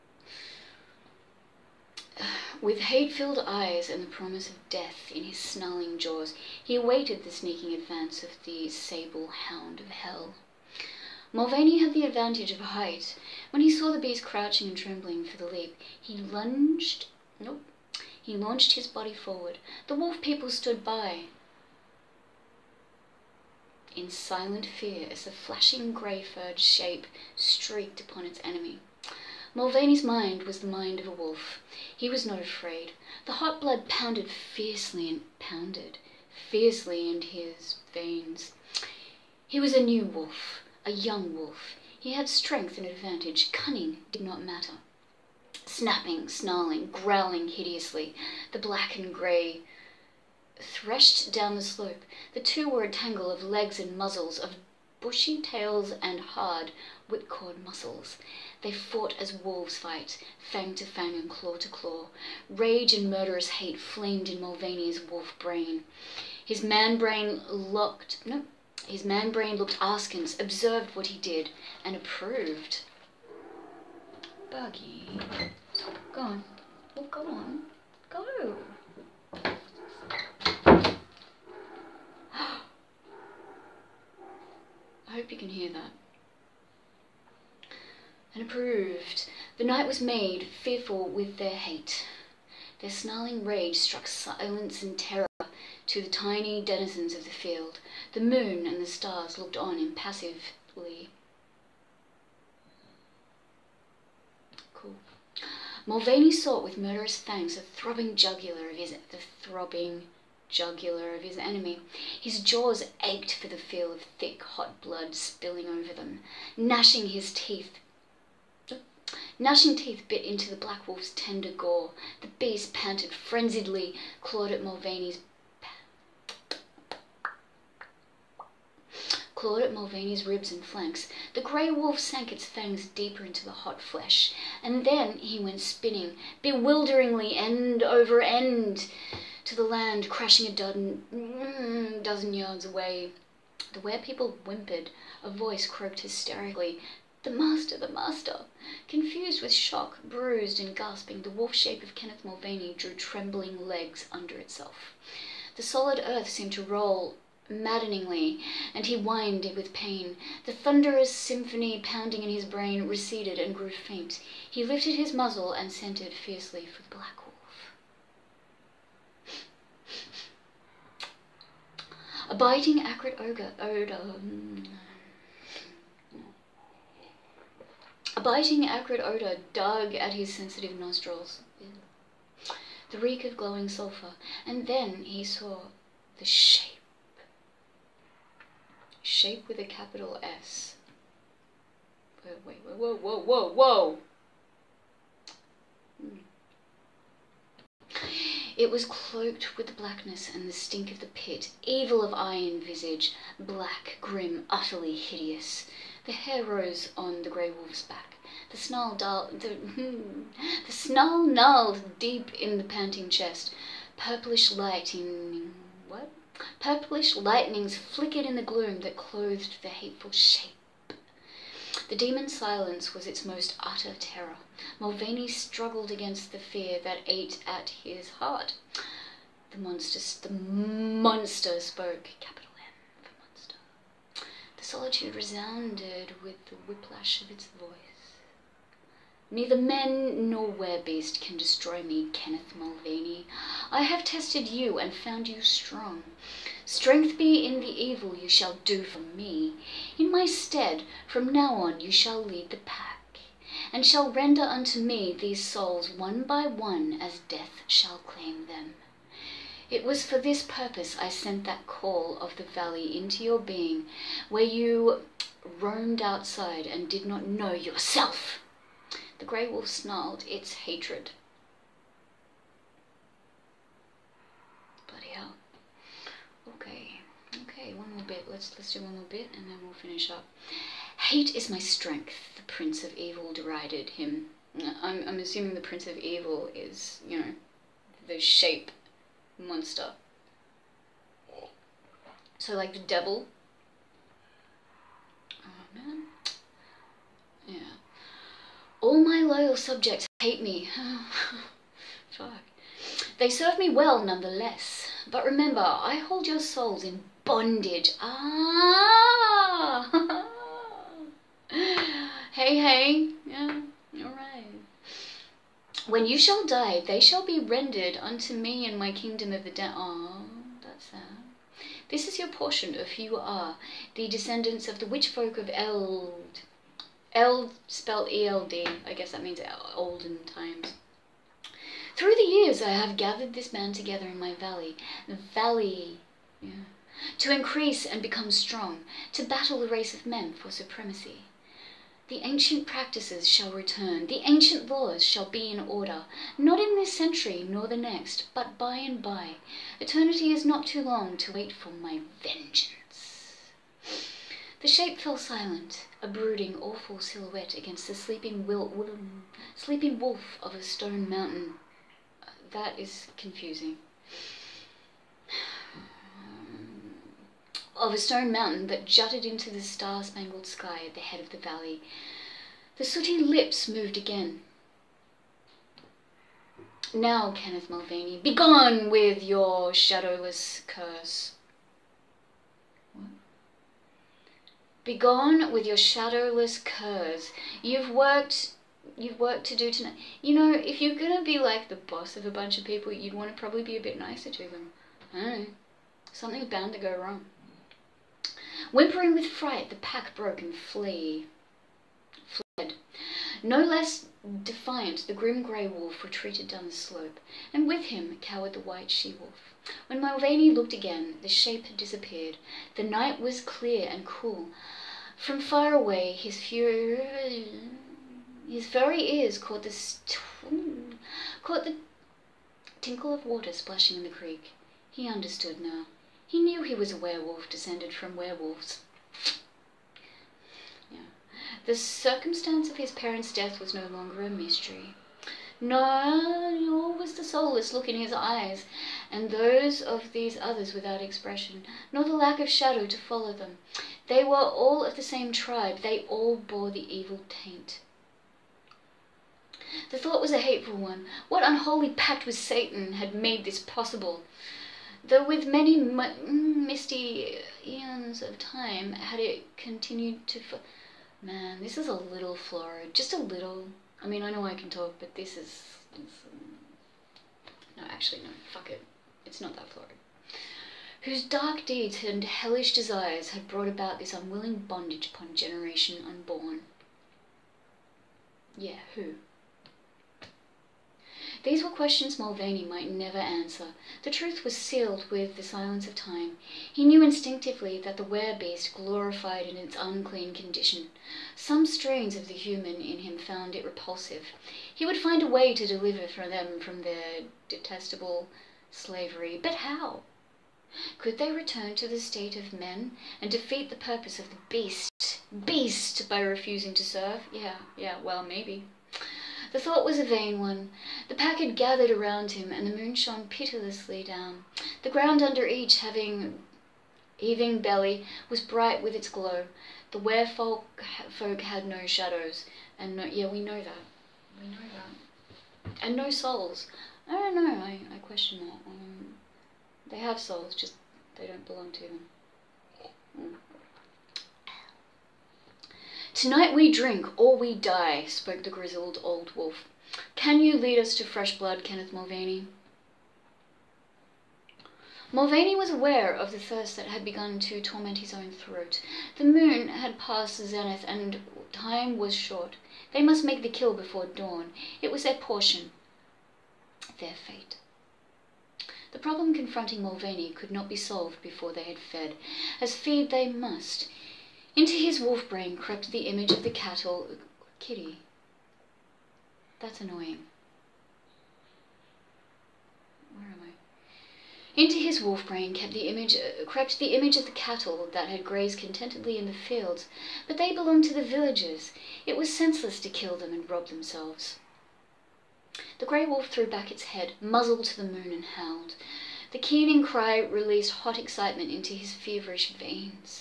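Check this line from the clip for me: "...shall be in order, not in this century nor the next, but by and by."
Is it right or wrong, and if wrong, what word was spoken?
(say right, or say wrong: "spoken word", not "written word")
right.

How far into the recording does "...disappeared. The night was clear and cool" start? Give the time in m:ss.
6:51.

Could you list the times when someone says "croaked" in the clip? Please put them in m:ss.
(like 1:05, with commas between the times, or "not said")
2:25.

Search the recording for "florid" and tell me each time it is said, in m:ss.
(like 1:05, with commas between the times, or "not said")
7:42, 7:49.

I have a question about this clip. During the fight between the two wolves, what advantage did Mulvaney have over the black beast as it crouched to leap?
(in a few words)
Height.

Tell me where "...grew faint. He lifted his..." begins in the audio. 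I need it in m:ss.
2:43.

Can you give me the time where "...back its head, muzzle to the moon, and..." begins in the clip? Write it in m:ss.
9:46.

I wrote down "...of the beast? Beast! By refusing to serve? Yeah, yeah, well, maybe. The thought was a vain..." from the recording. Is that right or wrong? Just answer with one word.
right.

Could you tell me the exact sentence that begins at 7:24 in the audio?
They were all of the same tribe, they all bore the evil taint.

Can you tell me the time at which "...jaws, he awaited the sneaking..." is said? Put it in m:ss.
0:05.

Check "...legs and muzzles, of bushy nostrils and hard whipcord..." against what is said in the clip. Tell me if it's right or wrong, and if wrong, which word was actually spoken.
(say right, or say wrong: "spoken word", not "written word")
wrong: "tails", not "nostrils".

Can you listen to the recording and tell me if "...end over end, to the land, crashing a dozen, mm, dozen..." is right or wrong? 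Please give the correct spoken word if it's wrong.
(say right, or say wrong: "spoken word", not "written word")
right.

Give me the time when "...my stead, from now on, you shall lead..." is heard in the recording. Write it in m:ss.
4:10.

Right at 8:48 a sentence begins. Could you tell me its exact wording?
Um, they have souls, just they don't belong to them.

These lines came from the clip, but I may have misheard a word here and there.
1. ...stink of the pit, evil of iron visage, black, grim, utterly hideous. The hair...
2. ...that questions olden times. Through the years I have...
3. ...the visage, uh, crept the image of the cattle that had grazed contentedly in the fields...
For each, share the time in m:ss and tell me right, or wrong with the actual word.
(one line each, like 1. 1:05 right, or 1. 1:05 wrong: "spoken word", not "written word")
1. 3:20 right
2. 5:29 wrong: "means", not "questions"
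3. 9:35 wrong: "image", not "visage".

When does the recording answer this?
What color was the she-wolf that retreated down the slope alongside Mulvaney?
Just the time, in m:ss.
6:48.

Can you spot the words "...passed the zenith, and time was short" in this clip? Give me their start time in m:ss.
9:09.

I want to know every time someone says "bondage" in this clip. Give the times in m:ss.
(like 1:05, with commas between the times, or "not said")
5:07, 7:54.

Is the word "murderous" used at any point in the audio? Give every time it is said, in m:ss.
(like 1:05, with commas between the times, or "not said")
1:03, 1:46.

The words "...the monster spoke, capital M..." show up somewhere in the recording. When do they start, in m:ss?
3:50.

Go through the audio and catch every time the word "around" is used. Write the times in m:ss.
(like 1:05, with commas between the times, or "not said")
8:31.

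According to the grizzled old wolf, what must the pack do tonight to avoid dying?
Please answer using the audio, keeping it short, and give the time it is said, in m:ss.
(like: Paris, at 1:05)
Drink, at 8:56.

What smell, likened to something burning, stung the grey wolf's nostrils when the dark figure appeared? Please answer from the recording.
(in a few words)
Glowing sulfur.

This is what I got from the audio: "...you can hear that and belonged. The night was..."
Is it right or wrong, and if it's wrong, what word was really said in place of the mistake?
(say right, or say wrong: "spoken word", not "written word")
wrong: "approved", not "belonged".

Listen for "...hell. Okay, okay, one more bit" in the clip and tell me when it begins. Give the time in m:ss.
4:35.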